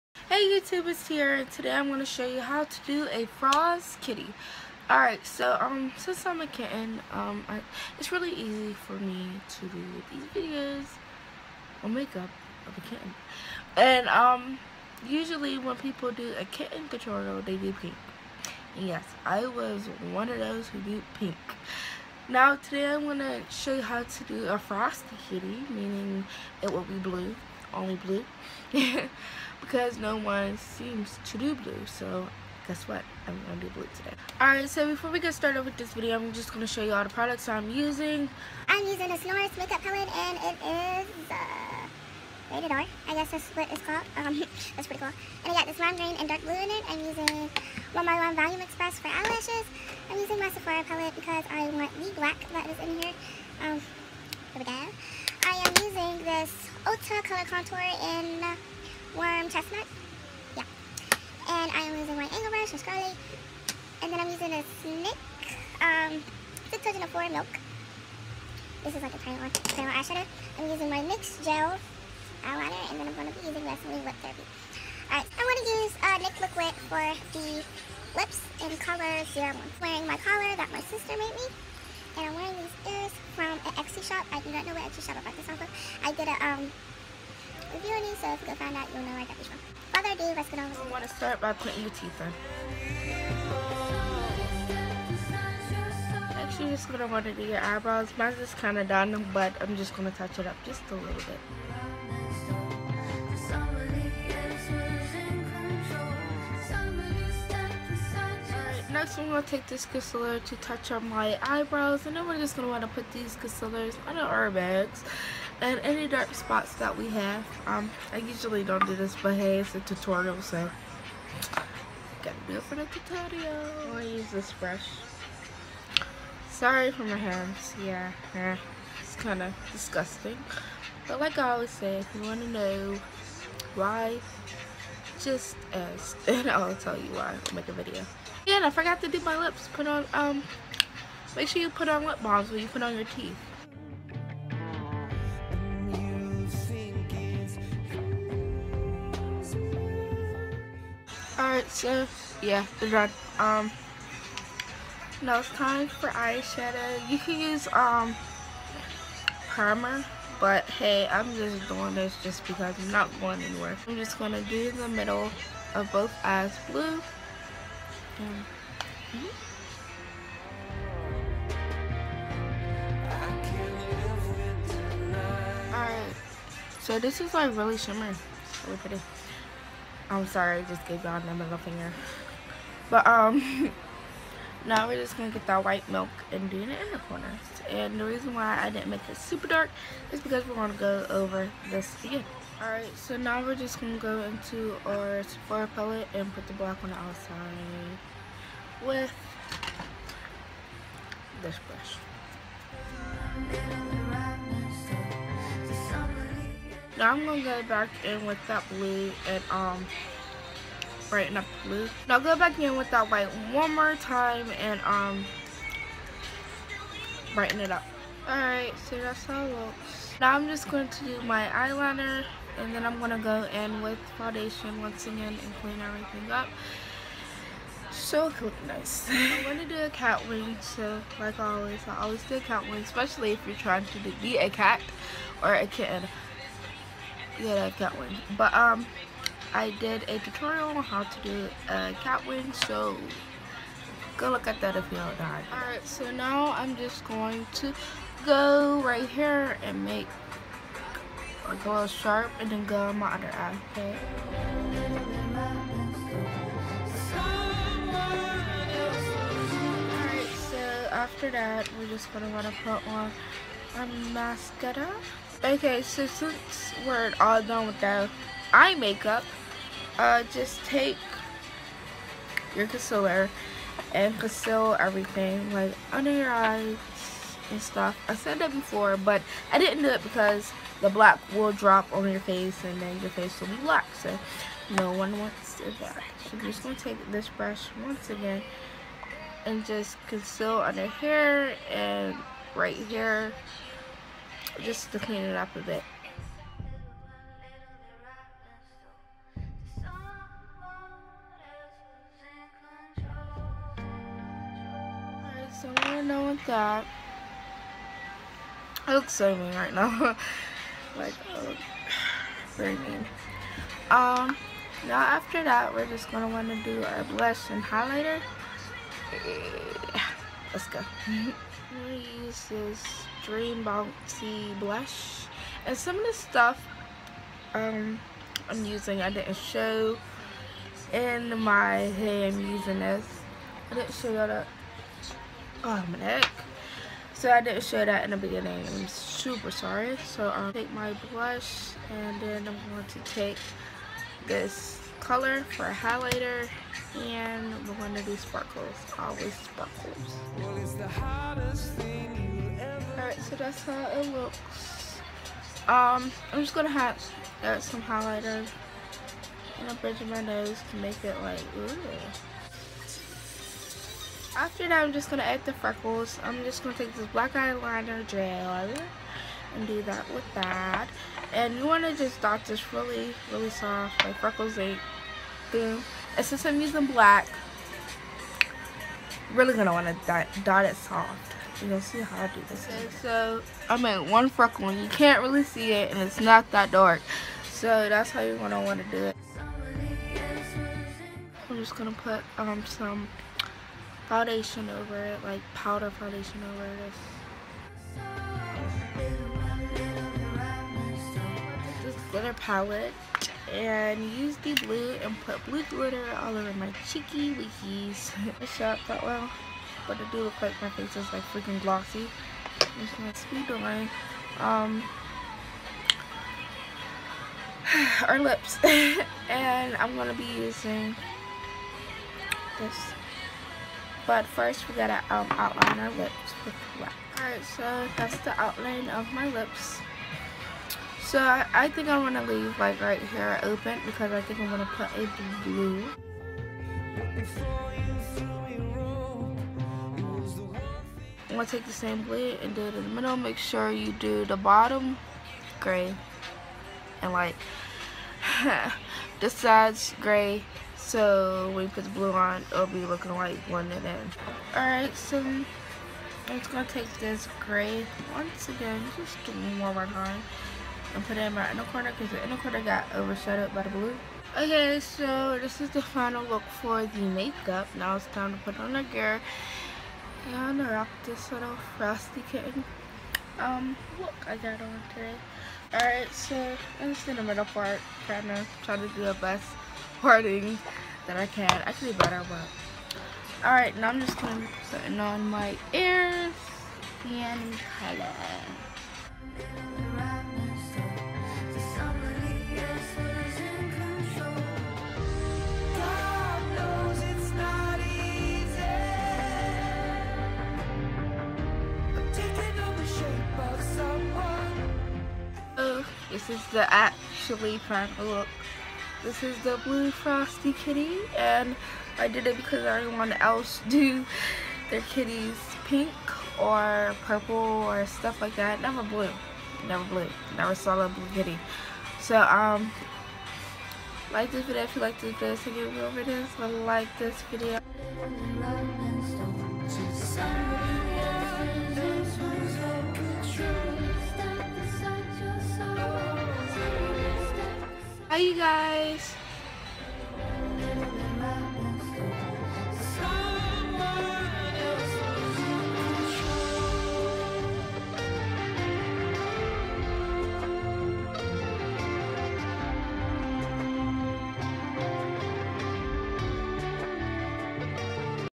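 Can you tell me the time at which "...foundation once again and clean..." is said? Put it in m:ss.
3:44.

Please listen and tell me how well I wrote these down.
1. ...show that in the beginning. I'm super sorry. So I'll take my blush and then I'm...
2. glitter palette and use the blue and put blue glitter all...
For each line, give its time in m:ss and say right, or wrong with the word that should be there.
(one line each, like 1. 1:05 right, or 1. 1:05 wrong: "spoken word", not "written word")
1. 5:37 right
2. 6:42 right.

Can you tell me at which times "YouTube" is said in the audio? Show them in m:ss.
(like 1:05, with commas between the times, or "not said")
0:00.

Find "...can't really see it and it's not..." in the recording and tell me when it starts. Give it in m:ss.
6:24.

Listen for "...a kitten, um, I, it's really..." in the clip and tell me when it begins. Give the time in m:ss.
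0:06.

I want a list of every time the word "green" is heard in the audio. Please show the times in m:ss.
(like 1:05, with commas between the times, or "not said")
0:45.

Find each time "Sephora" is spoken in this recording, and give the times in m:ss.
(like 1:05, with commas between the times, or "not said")
0:50, 3:15.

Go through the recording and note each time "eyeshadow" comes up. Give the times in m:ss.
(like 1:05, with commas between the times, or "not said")
1:09, 2:36.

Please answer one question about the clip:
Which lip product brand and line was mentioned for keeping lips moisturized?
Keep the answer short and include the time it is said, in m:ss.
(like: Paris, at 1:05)
Vaseline Lip Therapy, at 1:13.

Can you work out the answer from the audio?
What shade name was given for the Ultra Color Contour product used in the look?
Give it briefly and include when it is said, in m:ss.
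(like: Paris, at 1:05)
Warm Chestnut, at 0:59.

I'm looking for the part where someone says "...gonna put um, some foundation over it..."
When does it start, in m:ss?
6:31.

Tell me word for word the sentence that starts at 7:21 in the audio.
I'm gonna take the same blue and do it in the middle.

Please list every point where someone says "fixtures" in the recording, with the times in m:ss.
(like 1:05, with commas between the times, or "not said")
not said.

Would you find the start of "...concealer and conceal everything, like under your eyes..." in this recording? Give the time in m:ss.
4:32.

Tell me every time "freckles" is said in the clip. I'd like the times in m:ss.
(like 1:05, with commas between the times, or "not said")
6:05, 6:14, 6:24.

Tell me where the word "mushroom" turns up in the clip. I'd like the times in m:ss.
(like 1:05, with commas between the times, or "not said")
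not said.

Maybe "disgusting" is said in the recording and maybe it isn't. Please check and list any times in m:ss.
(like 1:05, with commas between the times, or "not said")
2:09.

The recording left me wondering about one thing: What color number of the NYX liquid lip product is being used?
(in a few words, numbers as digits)
01.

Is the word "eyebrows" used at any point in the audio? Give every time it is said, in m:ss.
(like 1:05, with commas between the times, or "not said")
1:37, 1:51.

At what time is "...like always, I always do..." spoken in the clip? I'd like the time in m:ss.
3:51.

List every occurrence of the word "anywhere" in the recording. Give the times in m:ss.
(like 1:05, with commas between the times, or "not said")
2:43.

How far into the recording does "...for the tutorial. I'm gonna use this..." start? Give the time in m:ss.
2:02.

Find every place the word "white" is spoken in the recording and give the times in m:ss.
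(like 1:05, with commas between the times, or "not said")
3:05, 3:33.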